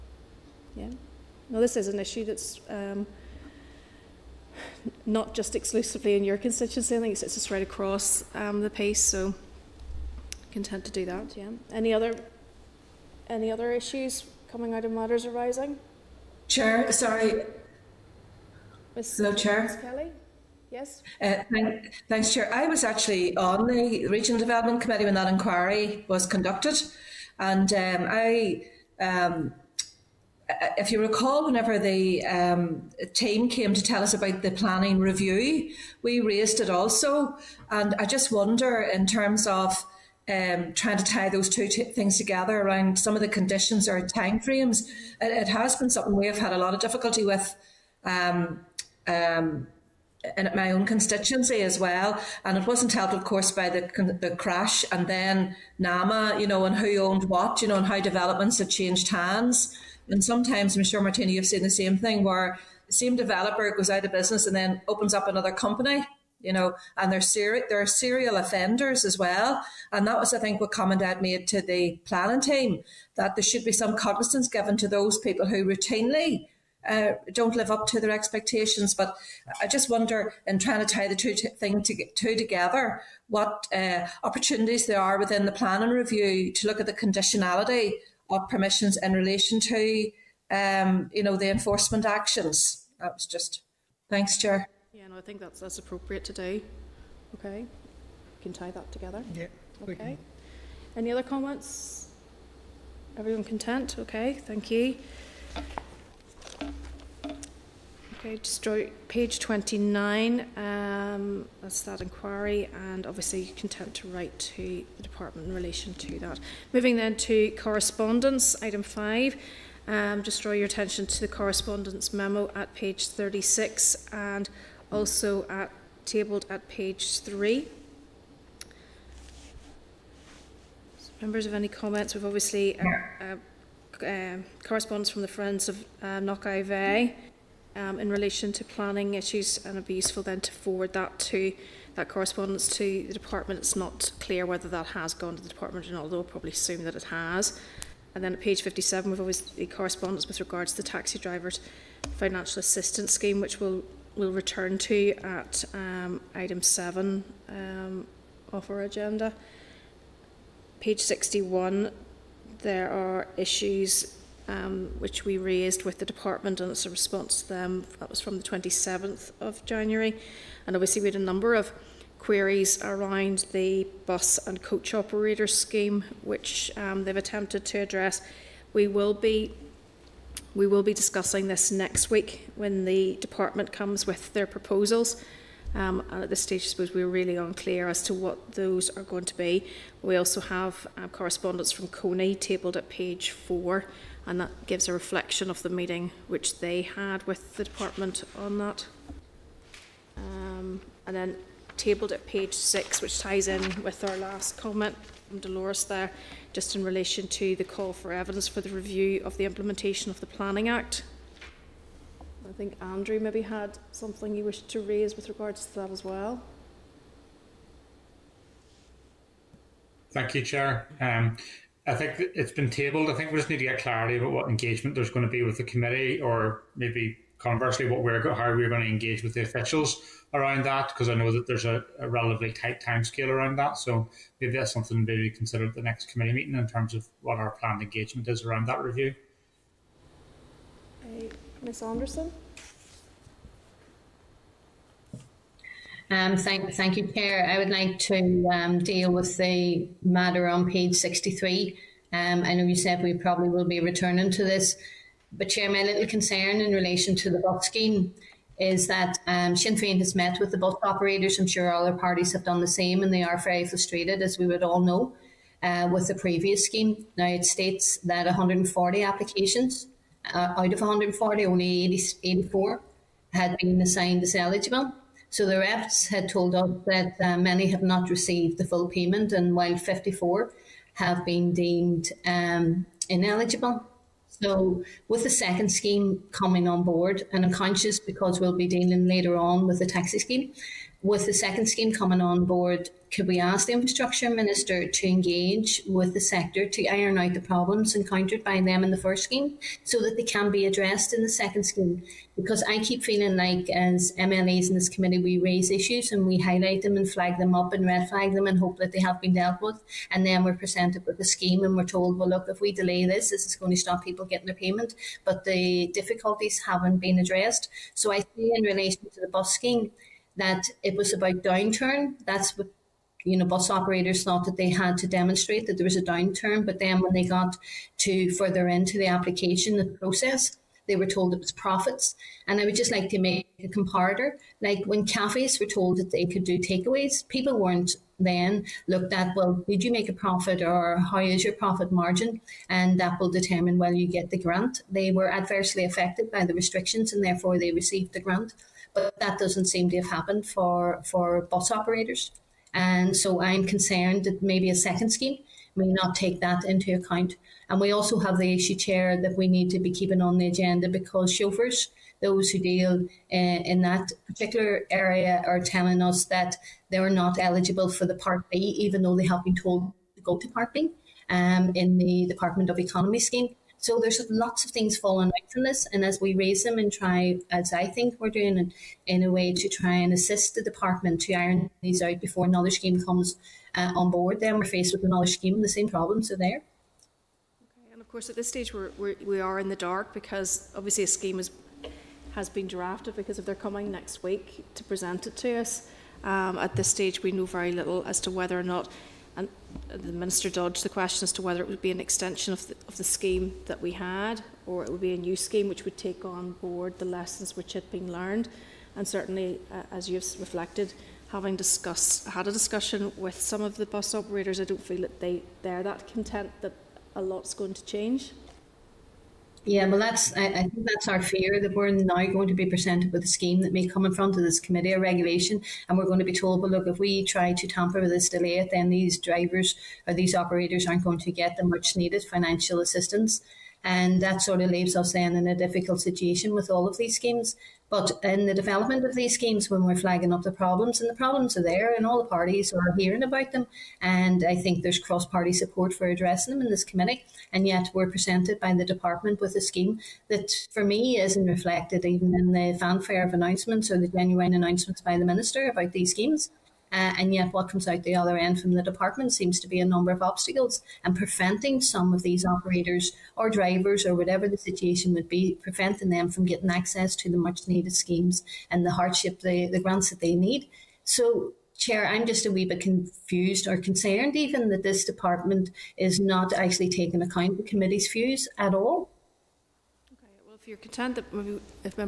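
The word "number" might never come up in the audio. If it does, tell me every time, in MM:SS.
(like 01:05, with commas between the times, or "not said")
02:51, 07:39.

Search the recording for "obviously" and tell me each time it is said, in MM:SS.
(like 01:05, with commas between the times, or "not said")
01:53, 02:12, 02:50, 06:30.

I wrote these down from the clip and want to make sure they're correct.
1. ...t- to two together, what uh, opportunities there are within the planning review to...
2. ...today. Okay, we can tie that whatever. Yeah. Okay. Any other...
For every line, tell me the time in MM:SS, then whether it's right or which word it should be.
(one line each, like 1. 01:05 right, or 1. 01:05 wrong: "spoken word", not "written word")
1. 01:21 right
2. 01:36 wrong: "together", not "whatever".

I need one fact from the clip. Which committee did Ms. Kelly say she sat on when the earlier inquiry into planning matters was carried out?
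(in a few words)
Regional Development Committee.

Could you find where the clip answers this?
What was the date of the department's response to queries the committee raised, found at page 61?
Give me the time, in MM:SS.
02:48.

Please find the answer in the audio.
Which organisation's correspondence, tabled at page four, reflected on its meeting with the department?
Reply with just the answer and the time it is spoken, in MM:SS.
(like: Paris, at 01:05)
Coney, at 03:11.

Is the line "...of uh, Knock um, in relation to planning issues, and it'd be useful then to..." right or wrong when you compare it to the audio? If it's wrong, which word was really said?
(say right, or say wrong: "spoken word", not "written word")
right.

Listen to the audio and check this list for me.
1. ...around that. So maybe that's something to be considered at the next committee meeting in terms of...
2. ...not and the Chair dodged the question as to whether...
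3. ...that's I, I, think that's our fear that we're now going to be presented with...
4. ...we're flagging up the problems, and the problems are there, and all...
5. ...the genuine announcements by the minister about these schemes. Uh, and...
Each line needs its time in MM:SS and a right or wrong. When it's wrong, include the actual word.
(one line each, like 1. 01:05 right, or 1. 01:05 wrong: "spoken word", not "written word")
1. 03:53 right
2. 06:38 wrong: "Minister", not "Chair"
3. 06:59 right
4. 07:19 right
5. 07:33 right.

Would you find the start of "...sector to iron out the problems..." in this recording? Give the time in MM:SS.
04:56.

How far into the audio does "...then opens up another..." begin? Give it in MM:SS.
01:04.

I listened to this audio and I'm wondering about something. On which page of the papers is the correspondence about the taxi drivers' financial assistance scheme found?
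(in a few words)
57.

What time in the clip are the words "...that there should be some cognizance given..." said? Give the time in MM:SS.
01:13.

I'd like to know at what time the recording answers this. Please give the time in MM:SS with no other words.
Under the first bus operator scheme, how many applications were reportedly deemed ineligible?
04:39.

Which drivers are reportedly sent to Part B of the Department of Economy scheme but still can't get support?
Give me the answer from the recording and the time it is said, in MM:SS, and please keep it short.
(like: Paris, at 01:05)
chauffeurs, at 06:01.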